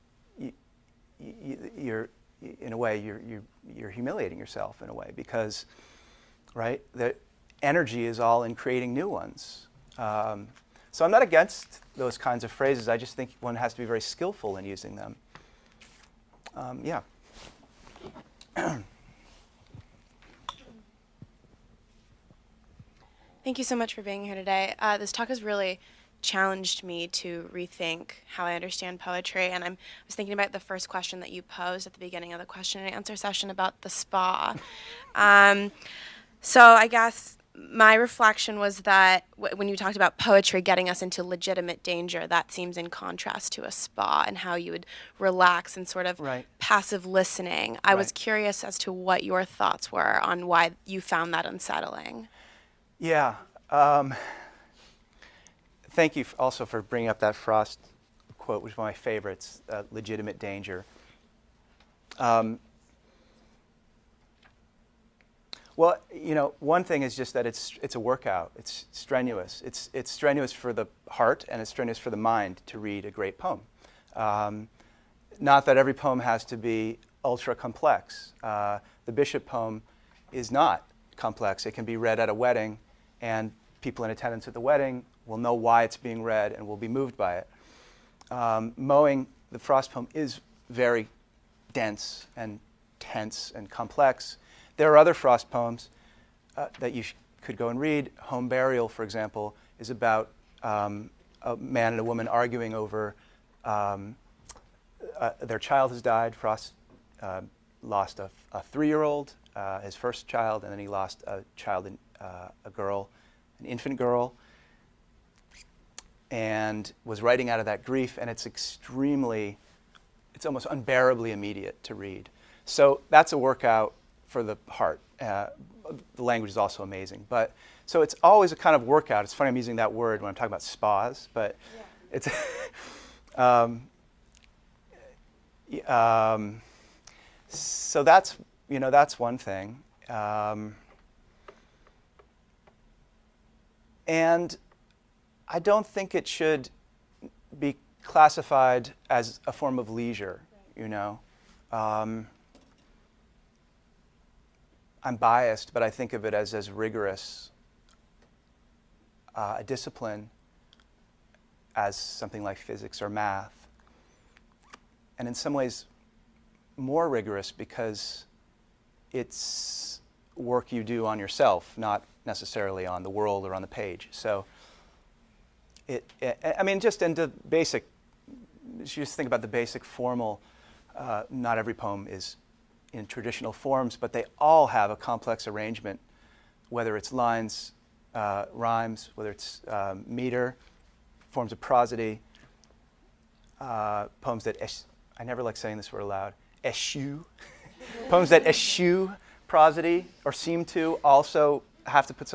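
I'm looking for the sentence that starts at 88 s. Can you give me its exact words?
Um, mowing, the Frost poem, is very dense and tense and complex.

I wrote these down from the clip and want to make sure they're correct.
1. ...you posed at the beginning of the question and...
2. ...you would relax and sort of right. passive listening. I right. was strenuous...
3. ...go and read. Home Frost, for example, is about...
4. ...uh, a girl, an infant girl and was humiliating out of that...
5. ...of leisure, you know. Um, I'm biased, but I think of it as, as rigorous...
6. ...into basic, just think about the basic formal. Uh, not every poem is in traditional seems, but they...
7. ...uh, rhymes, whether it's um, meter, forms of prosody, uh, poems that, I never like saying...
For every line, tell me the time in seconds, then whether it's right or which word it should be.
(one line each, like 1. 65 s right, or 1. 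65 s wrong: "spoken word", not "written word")
1. 31 s right
2. 44 s wrong: "curious", not "strenuous"
3. 97 s wrong: "Burial", not "Frost"
4. 112 s wrong: "writing", not "humiliating"
5. 149 s right
6. 177 s wrong: "forms", not "seems"
7. 188 s right.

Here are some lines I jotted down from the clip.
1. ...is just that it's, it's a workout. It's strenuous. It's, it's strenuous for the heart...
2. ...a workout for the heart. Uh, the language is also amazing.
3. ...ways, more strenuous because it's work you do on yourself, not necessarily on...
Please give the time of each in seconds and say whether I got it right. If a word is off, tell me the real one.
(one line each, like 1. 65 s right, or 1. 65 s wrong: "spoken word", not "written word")
1. 67 s right
2. 123 s right
3. 165 s wrong: "rigorous", not "strenuous".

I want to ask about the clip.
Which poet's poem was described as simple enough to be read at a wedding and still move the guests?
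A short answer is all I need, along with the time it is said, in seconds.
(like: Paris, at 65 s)
Bishop, at 79 s.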